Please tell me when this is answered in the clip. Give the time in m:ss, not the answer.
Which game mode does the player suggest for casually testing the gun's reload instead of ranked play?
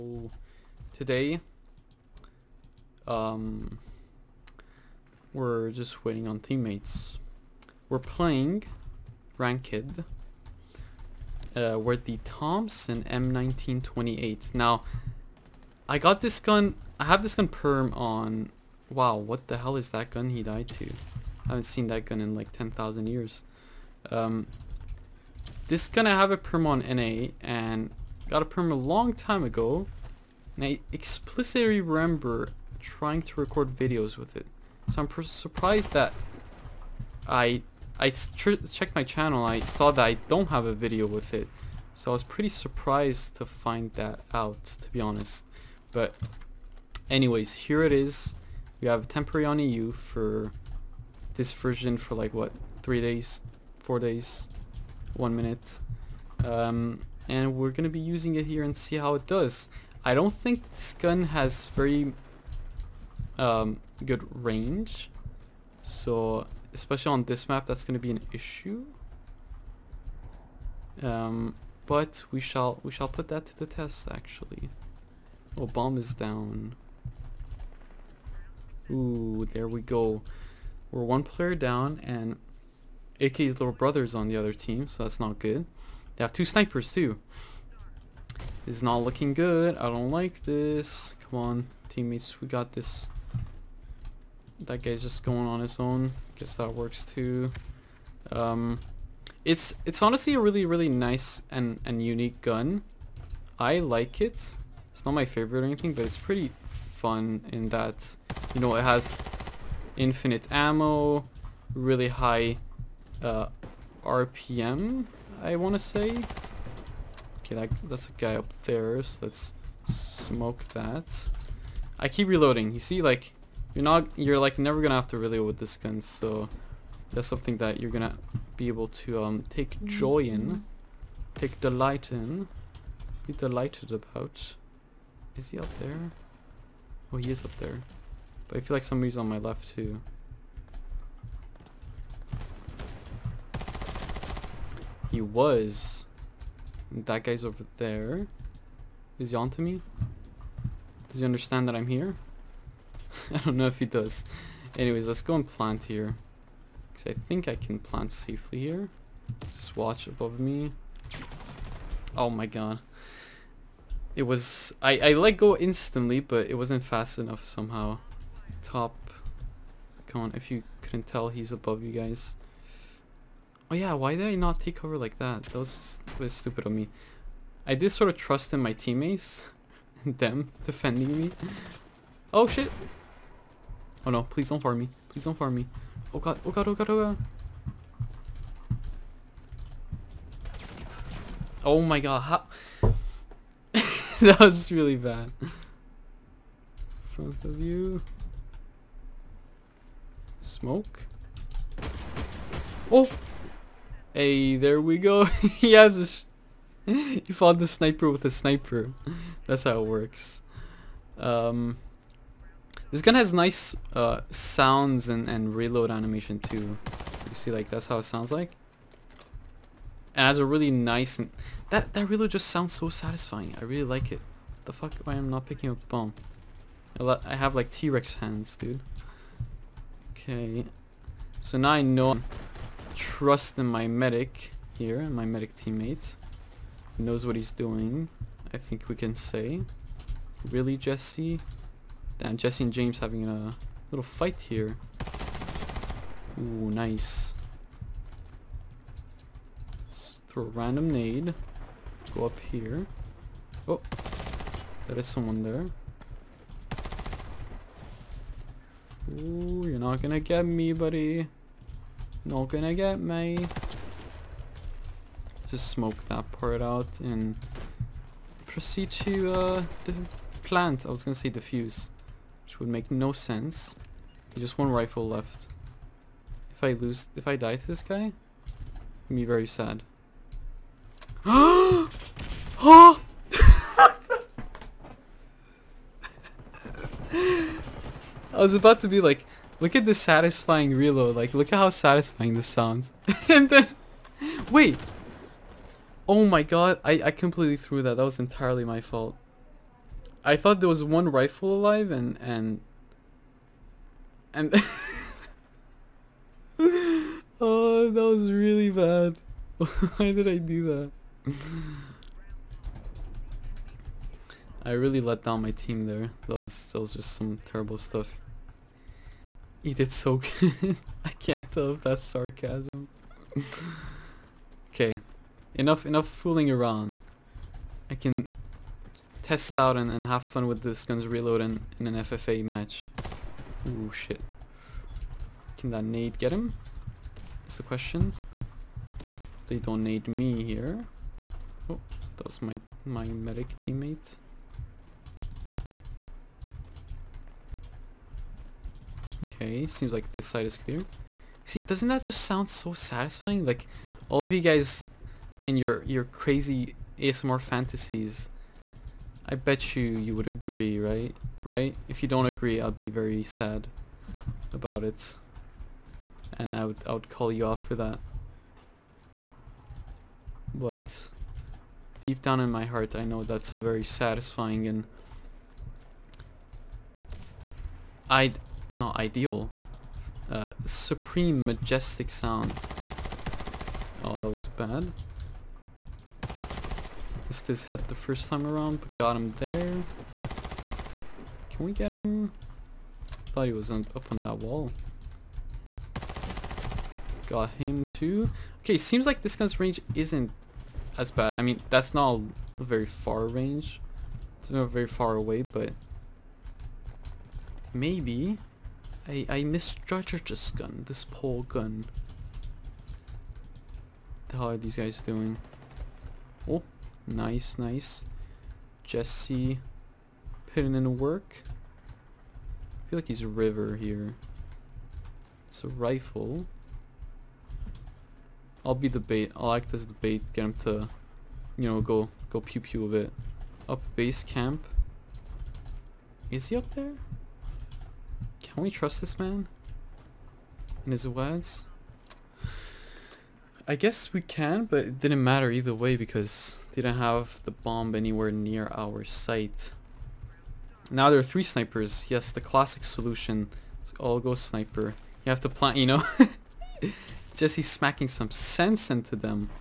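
5:31.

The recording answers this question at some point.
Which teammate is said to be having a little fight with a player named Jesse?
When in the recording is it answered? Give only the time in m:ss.
4:02.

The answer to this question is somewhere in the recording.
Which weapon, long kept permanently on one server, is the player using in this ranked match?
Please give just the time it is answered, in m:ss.
0:12.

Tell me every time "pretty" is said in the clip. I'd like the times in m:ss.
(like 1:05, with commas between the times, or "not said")
0:42, 1:46.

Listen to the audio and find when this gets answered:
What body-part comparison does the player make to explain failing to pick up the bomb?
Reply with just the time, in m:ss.
3:47.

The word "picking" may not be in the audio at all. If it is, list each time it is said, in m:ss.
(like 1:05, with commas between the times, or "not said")
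3:45.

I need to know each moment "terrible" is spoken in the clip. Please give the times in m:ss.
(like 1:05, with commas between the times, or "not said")
5:17.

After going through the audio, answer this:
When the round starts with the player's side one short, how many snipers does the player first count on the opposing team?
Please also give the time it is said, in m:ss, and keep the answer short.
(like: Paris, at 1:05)
2, at 1:26.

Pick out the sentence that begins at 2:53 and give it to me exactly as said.
Oh yeah, why did I not take cover like that?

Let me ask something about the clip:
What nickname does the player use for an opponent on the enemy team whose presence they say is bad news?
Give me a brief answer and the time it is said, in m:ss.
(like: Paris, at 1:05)
AK's little brother, at 1:23.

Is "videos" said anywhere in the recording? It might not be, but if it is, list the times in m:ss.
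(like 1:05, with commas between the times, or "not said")
0:33, 0:40.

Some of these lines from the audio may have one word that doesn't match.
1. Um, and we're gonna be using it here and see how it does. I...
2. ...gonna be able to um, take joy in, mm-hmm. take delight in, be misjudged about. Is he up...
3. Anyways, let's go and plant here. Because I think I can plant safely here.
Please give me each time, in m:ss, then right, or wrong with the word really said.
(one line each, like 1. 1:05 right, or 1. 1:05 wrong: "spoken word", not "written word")
1. 0:56 right
2. 2:07 wrong: "delighted", not "misjudged"
3. 2:34 right.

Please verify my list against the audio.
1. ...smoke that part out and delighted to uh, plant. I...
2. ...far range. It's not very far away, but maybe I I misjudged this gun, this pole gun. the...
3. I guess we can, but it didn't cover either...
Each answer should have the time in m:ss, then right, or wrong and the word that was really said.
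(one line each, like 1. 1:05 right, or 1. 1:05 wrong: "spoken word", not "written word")
1. 4:25 wrong: "proceed", not "delighted"
2. 6:42 right
3. 7:23 wrong: "matter", not "cover".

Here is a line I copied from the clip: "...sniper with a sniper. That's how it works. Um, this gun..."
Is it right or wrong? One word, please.
right.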